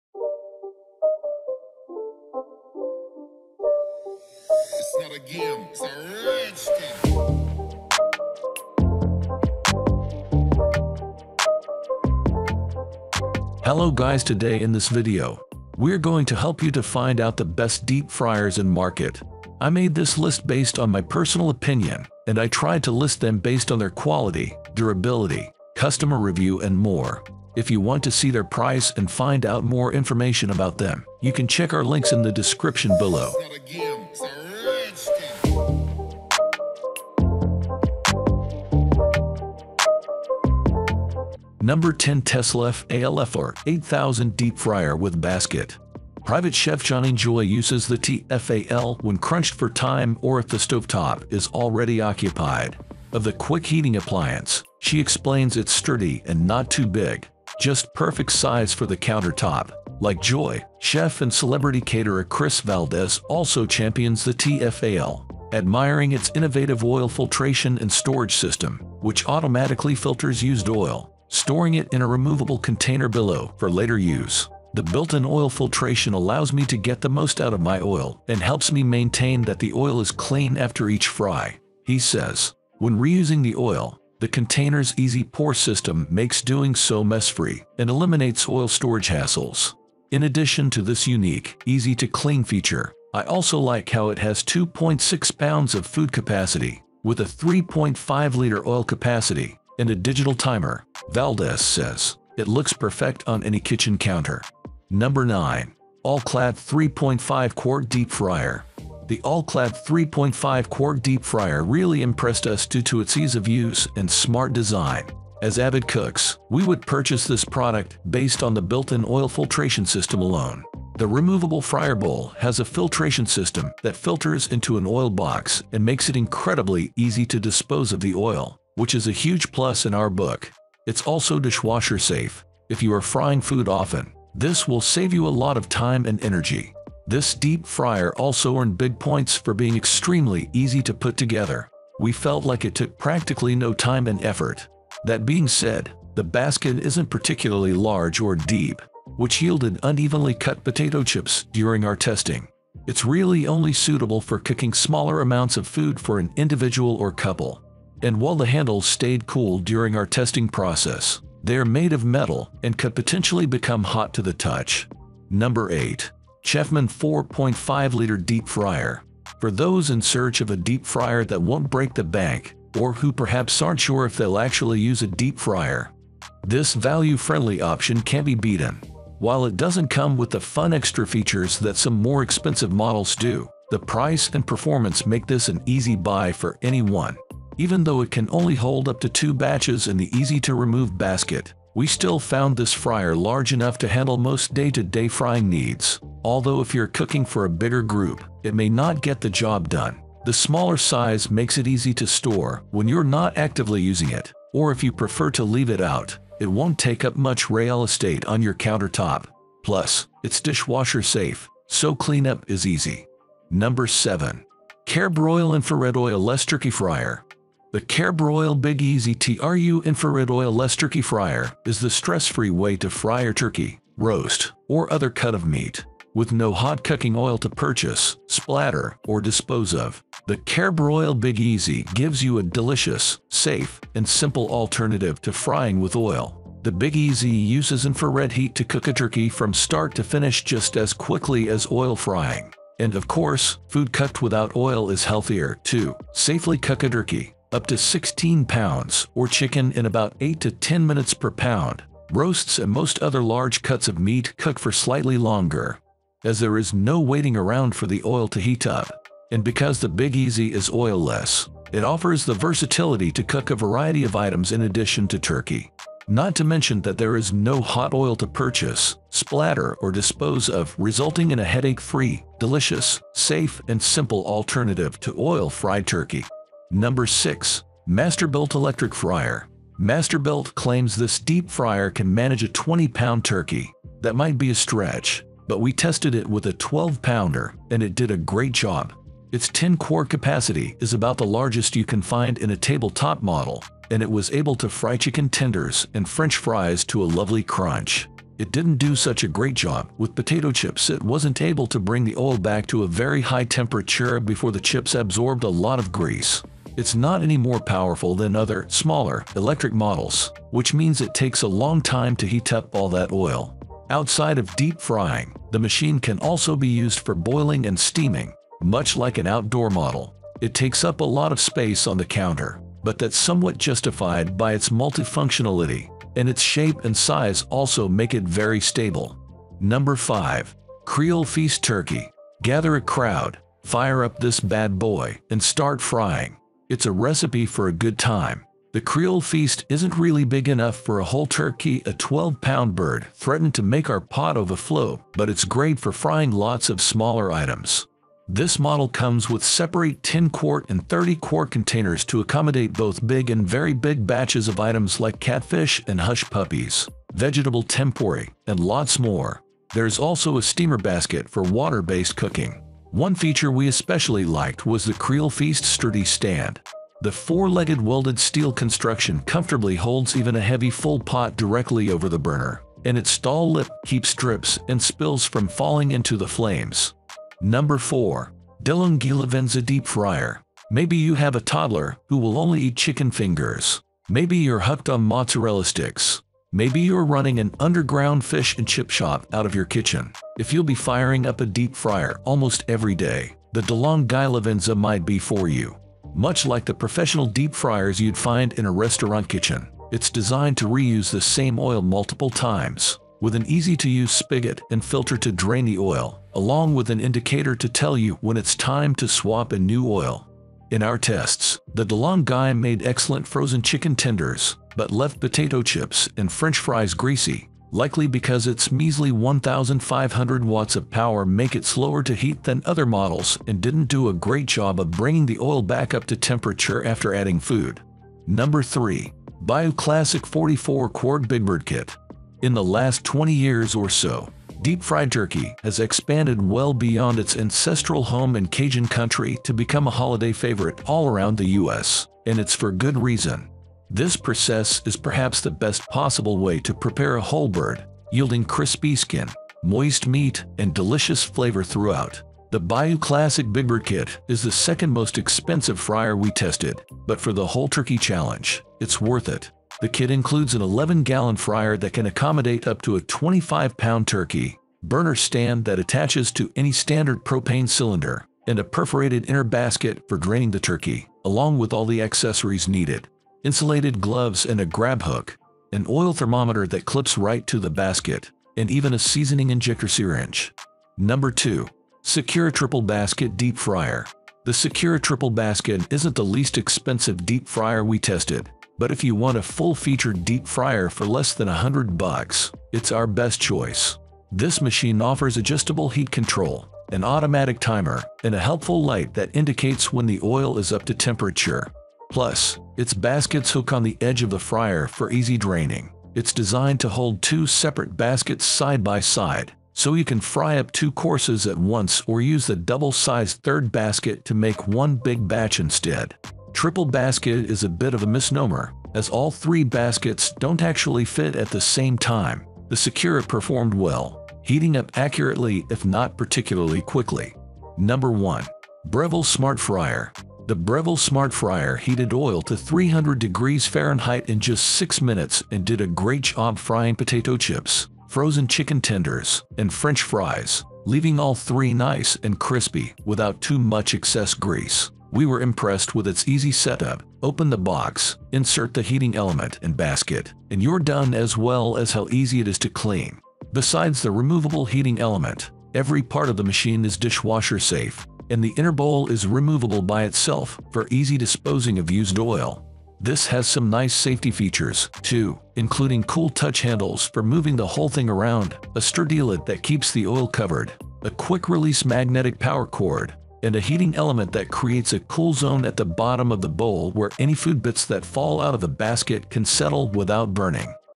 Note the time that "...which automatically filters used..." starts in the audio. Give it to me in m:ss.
1:09.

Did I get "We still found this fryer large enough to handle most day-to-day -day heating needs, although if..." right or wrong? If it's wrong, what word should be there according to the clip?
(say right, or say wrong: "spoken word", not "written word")
wrong: "frying", not "heating".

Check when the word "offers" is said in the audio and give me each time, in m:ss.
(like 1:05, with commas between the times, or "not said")
4:21, 8:15.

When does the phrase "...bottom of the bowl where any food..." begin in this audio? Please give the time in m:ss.
9:35.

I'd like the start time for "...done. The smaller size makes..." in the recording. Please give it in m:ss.
3:19.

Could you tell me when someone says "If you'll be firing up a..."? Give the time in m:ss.
6:30.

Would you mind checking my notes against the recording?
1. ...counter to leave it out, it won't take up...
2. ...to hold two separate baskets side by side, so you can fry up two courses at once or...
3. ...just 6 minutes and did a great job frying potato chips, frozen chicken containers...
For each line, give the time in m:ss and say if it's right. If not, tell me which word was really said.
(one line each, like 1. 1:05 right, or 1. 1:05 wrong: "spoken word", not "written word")
1. 3:24 wrong: "prefer", not "counter"
2. 8:26 right
3. 8:54 wrong: "tenders", not "containers".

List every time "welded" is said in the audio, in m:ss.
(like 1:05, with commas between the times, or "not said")
6:07.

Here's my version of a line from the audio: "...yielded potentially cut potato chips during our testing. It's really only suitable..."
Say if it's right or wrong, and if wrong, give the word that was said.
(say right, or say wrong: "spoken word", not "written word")
wrong: "unevenly", not "potentially".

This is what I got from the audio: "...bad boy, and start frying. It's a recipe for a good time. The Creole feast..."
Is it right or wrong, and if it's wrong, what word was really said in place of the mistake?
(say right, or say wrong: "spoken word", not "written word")
right.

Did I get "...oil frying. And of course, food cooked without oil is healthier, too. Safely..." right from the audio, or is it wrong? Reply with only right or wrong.
right.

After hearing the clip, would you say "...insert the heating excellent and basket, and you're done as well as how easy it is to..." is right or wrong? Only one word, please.
wrong.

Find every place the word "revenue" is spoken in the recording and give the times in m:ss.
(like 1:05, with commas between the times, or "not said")
not said.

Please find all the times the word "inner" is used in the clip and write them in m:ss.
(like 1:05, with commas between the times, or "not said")
7:49, 9:18.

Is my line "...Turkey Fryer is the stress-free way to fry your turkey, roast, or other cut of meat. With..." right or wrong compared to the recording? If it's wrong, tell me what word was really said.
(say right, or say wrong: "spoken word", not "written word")
right.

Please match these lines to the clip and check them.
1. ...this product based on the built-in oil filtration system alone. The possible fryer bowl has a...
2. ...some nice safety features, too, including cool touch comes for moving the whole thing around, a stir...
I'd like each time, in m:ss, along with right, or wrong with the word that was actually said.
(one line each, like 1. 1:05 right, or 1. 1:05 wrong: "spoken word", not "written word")
1. 1:57 wrong: "removable", not "possible"
2. 9:23 wrong: "handles", not "comes".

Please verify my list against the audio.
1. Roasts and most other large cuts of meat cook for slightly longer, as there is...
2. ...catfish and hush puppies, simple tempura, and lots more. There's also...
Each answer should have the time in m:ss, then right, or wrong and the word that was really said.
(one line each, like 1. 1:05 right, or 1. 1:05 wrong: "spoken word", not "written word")
1. 4:12 right
2. 5:55 wrong: "vegetable", not "simple".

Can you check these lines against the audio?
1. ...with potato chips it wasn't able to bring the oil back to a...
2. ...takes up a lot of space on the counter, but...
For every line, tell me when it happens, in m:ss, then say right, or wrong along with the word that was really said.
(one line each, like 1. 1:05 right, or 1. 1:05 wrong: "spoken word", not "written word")
1. 4:59 right
2. 5:20 right.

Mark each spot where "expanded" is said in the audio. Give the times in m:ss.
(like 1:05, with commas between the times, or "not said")
7:15.